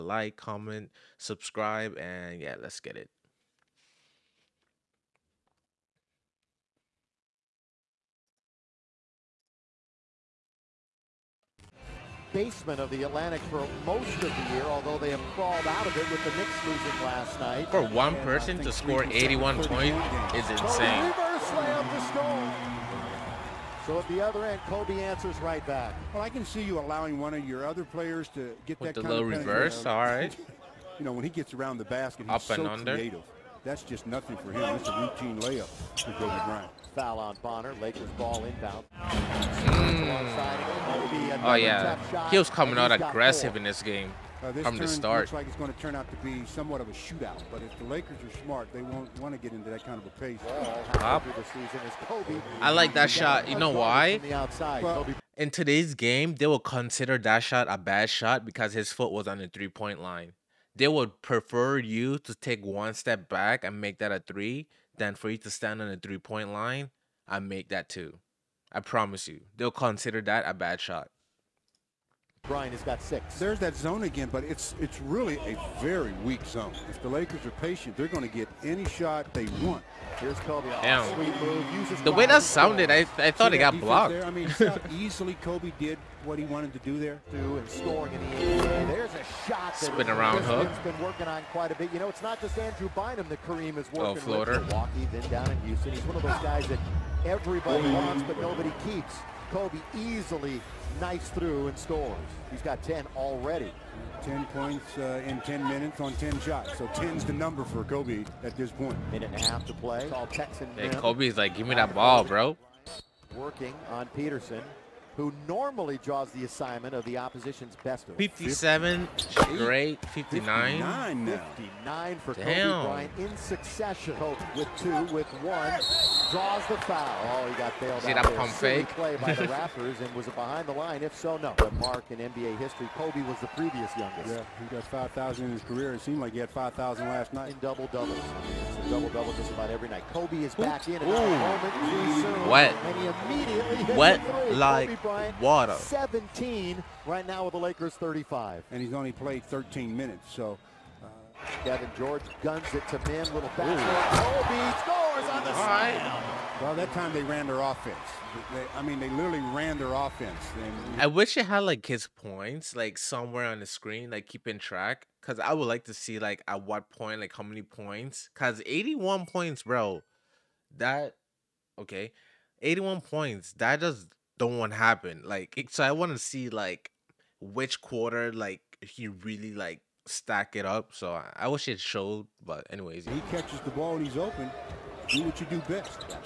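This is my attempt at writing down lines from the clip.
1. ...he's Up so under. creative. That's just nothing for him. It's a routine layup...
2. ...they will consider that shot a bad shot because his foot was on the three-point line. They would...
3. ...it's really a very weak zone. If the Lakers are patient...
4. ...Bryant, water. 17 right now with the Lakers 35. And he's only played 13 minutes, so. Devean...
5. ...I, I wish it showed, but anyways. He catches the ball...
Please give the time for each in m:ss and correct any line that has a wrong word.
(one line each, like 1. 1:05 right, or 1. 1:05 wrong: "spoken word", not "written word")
1. 0:32 right
2. 0:56 right
3. 1:14 right
4. 2:25 right
5. 3:01 right.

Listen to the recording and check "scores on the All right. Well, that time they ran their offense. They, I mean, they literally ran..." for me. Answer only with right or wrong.
right.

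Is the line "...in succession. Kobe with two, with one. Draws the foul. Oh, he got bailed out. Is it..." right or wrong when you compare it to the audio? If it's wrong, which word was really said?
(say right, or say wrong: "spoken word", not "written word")
right.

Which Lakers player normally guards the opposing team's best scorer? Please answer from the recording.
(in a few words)
Peterson.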